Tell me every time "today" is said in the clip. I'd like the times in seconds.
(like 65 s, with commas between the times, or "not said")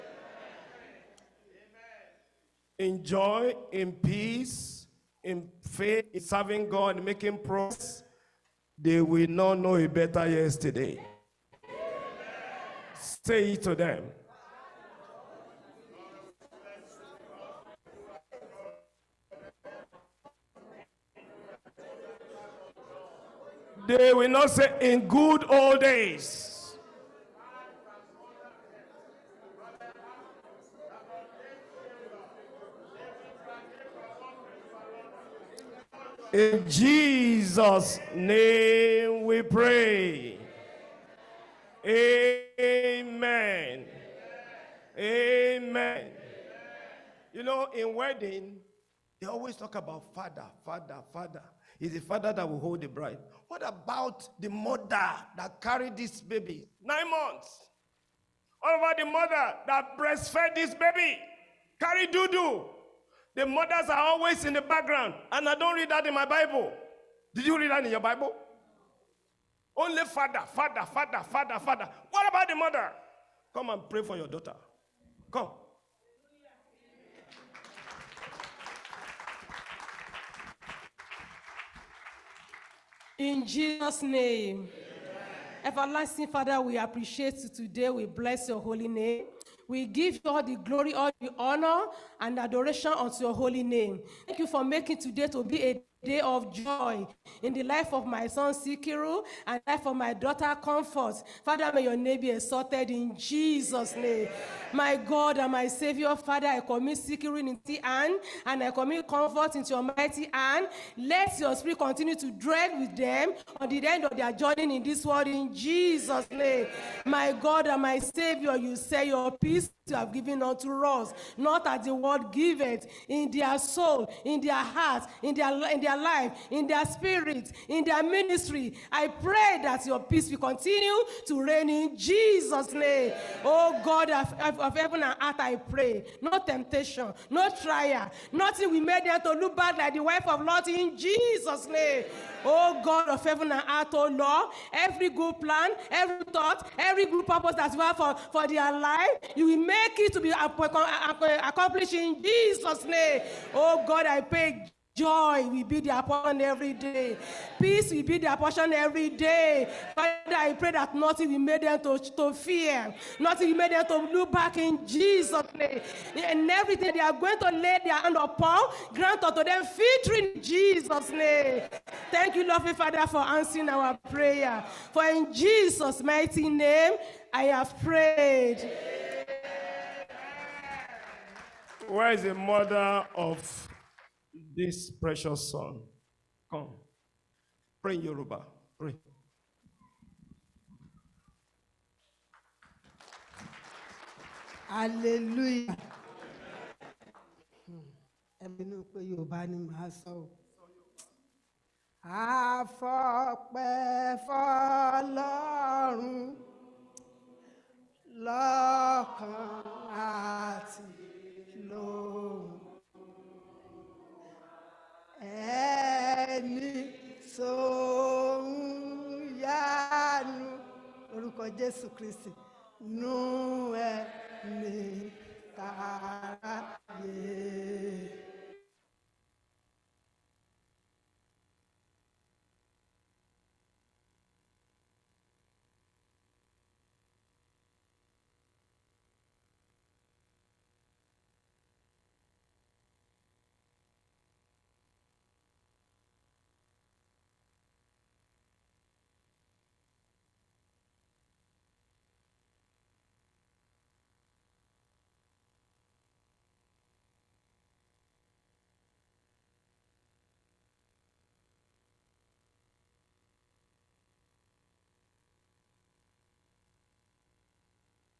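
87 s, 94 s.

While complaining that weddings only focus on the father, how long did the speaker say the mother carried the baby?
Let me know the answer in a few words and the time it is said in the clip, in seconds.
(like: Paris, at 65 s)
9 months, at 56 s.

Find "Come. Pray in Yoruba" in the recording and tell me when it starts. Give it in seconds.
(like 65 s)
186 s.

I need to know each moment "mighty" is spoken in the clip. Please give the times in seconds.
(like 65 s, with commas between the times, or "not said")
109 s, 176 s.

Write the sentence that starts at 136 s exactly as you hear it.
No temptation, no trial, nothing we made there to look bad like the wife of Lot in Jesus' name.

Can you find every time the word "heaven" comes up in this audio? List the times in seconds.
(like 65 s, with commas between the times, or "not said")
134 s, 143 s.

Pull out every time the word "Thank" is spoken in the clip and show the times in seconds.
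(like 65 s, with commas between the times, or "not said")
94 s, 172 s.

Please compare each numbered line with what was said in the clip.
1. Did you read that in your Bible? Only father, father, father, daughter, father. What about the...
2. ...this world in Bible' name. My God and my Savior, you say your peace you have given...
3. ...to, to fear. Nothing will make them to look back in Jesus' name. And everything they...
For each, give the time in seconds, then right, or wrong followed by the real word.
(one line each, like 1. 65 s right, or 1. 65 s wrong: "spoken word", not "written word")
1. 67 s wrong: "father", not "daughter"
2. 114 s wrong: "Jesus", not "Bible"
3. 161 s right.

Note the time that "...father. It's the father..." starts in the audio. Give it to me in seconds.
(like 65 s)
51 s.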